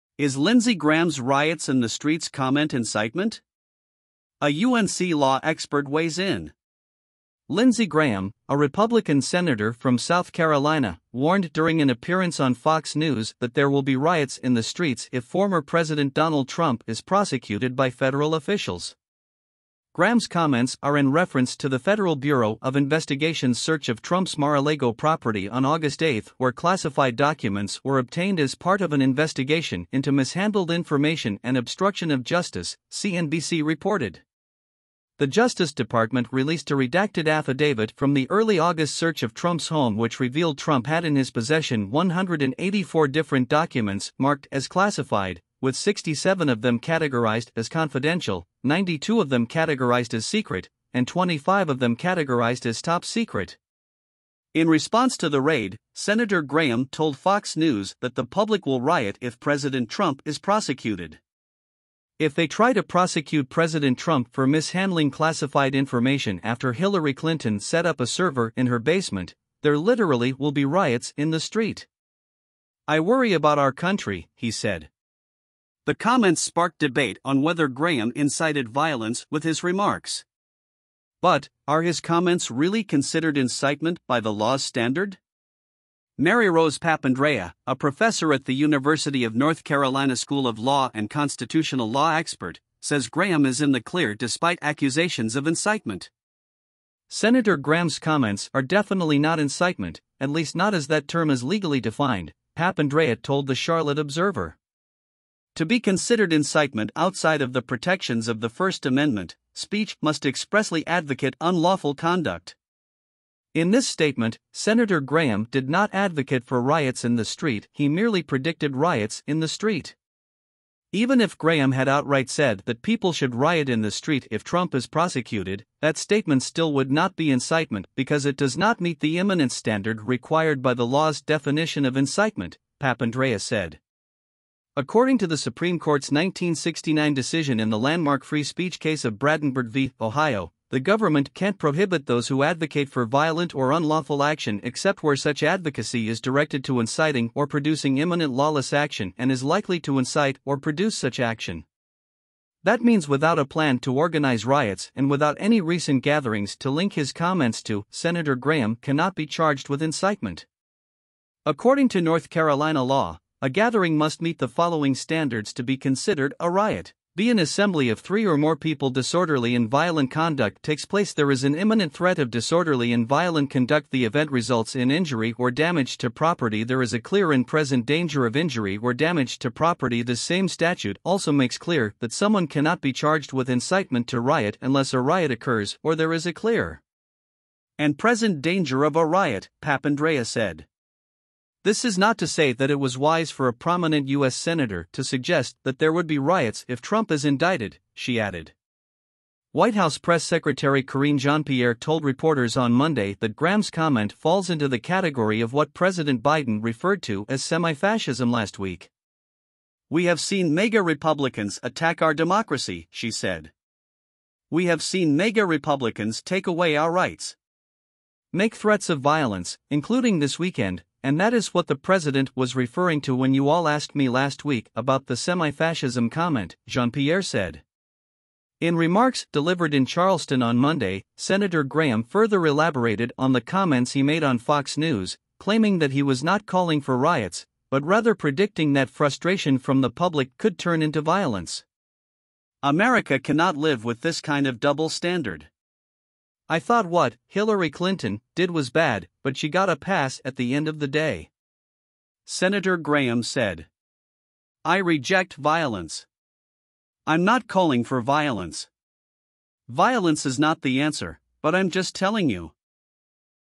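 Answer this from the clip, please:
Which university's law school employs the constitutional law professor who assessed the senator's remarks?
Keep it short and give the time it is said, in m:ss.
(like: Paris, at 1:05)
University of North Carolina, at 1:28.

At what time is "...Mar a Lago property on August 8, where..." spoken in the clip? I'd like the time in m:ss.
0:24.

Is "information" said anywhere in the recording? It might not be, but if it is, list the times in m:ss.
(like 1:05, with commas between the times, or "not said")
0:30, 1:05.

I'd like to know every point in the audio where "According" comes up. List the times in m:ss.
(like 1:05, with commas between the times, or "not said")
2:14, 2:41.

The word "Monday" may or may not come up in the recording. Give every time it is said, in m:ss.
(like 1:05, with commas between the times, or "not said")
3:22, 3:50.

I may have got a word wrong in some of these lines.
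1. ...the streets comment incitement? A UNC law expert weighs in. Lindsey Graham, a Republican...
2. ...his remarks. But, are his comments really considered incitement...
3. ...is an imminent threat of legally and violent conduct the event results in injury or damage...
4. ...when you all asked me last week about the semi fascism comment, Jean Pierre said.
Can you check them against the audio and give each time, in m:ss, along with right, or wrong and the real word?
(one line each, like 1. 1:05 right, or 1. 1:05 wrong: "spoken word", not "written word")
1. 0:01 right
2. 1:19 right
3. 2:51 wrong: "disorderly", not "legally"
4. 3:43 right.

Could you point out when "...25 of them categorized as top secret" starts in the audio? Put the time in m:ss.
0:51.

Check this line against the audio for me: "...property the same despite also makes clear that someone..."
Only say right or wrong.
wrong.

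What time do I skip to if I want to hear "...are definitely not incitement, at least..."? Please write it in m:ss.
1:38.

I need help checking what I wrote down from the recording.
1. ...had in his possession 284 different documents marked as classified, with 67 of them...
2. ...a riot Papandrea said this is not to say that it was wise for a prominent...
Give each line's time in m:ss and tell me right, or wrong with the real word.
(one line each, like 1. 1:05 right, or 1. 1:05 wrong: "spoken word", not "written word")
1. 0:40 wrong: "184", not "284"
2. 3:08 right.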